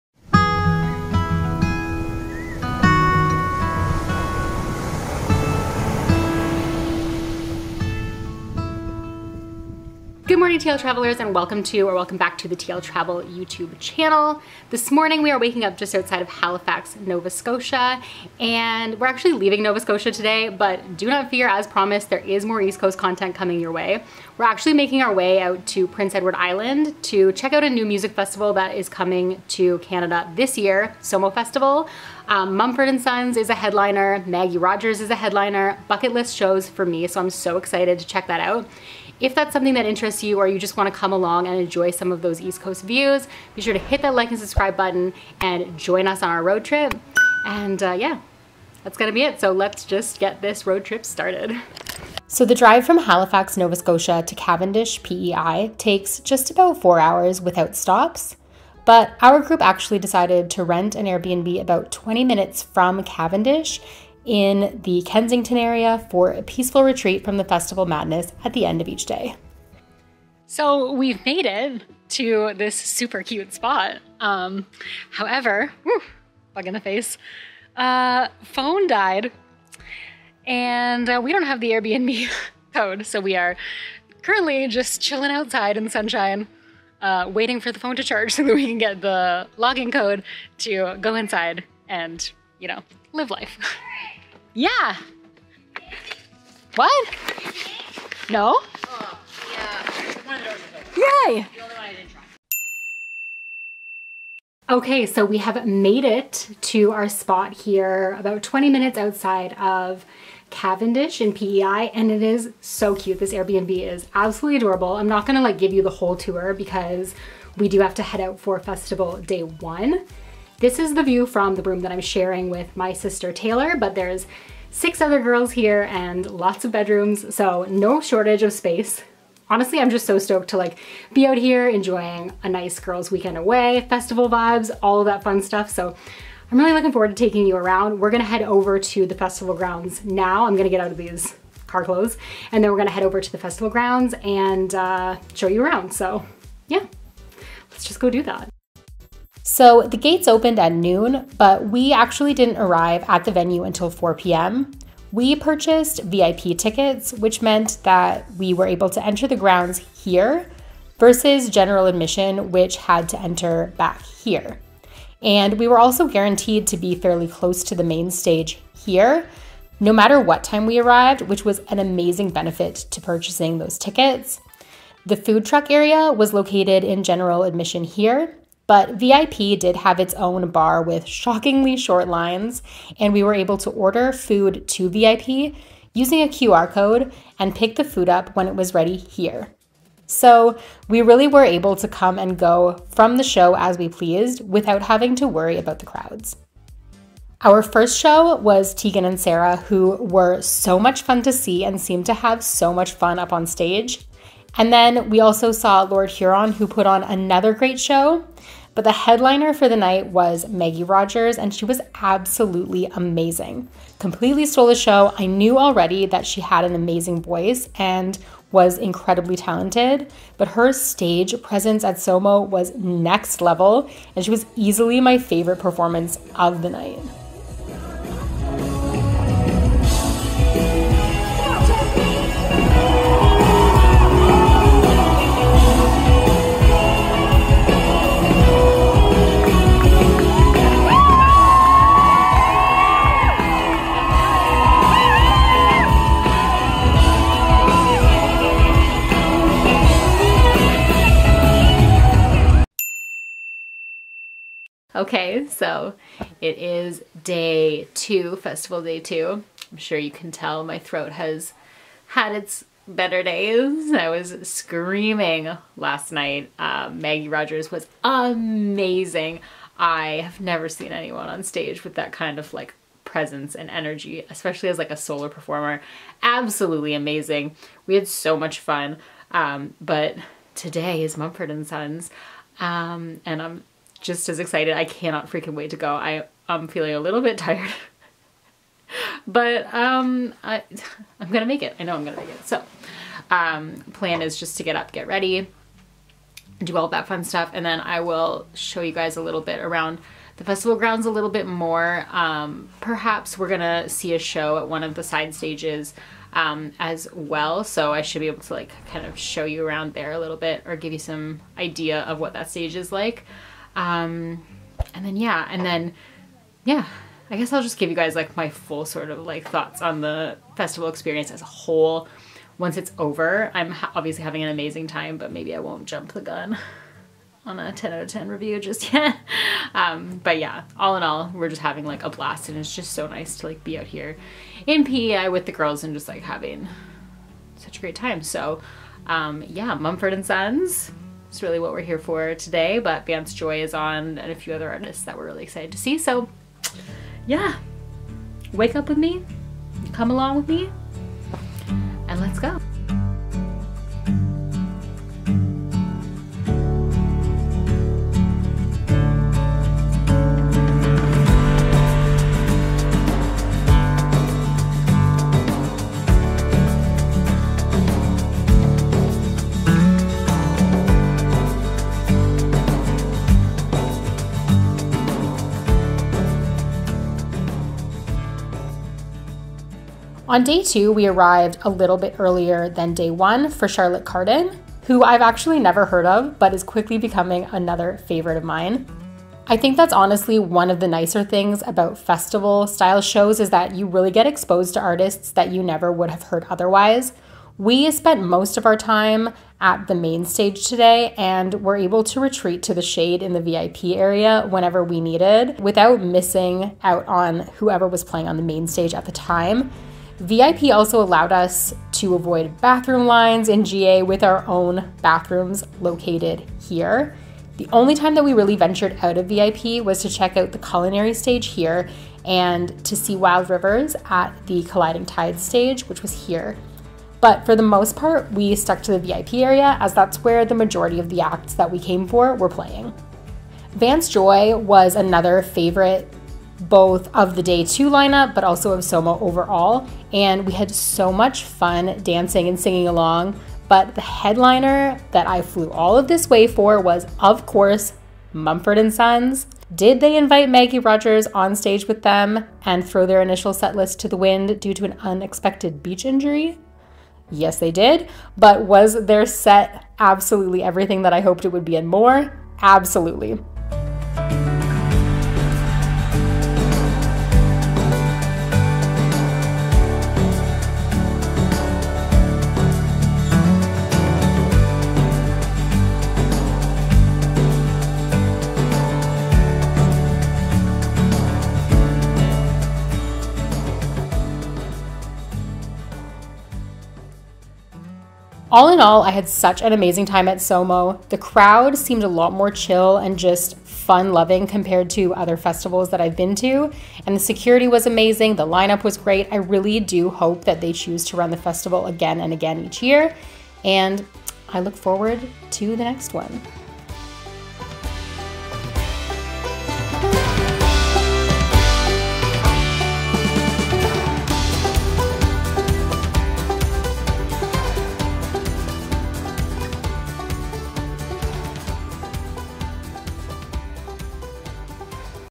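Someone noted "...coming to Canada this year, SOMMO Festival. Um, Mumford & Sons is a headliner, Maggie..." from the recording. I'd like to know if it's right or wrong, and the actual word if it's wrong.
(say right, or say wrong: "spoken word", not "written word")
right.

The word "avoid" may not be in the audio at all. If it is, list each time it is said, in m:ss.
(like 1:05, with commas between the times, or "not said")
6:52.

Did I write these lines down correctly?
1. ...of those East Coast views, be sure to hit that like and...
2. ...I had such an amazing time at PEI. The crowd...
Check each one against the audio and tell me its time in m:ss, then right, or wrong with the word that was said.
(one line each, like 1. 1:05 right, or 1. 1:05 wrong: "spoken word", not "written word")
1. 0:42 right
2. 8:09 wrong: "SOMMO", not "PEI".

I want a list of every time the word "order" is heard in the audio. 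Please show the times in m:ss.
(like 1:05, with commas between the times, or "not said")
3:03.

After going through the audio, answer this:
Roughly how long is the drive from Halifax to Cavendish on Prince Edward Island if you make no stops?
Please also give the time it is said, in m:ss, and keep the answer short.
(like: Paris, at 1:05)
4 hours, at 0:56.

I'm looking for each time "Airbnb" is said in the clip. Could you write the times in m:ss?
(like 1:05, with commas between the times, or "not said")
1:01, 1:21, 1:53.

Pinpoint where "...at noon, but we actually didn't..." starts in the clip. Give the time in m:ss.
2:30.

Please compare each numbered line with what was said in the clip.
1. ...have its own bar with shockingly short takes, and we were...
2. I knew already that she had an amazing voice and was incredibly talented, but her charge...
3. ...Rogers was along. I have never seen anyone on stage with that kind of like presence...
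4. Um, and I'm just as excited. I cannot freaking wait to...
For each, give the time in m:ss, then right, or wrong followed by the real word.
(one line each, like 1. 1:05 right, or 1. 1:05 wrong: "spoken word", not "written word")
1. 2:59 wrong: "lines", not "takes"
2. 3:35 wrong: "stage", not "charge"
3. 4:27 wrong: "amazing", not "along"
4. 4:42 right.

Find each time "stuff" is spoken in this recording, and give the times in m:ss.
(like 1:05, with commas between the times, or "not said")
2:15, 4:57.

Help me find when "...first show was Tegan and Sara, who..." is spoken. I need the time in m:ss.
3:17.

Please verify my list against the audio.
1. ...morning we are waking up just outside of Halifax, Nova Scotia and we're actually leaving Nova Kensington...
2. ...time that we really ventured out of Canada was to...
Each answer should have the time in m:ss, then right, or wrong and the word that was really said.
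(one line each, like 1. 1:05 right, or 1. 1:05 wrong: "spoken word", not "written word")
1. 0:14 wrong: "Scotia", not "Kensington"
2. 6:57 wrong: "VIP", not "Canada".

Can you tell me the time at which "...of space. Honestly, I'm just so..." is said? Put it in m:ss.
2:08.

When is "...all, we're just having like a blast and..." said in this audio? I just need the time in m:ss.
5:31.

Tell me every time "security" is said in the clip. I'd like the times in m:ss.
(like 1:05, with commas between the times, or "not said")
8:17.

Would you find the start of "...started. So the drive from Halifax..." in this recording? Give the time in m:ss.
0:51.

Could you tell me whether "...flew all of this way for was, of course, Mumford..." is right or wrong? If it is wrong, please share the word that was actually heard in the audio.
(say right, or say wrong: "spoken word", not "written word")
right.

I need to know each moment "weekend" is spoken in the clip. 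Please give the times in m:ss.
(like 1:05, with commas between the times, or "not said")
2:13.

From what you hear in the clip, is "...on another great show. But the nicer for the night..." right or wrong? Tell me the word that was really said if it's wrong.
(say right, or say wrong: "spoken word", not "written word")
wrong: "headliner", not "nicer".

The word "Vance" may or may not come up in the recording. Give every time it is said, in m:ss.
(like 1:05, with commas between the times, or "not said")
5:43, 7:13.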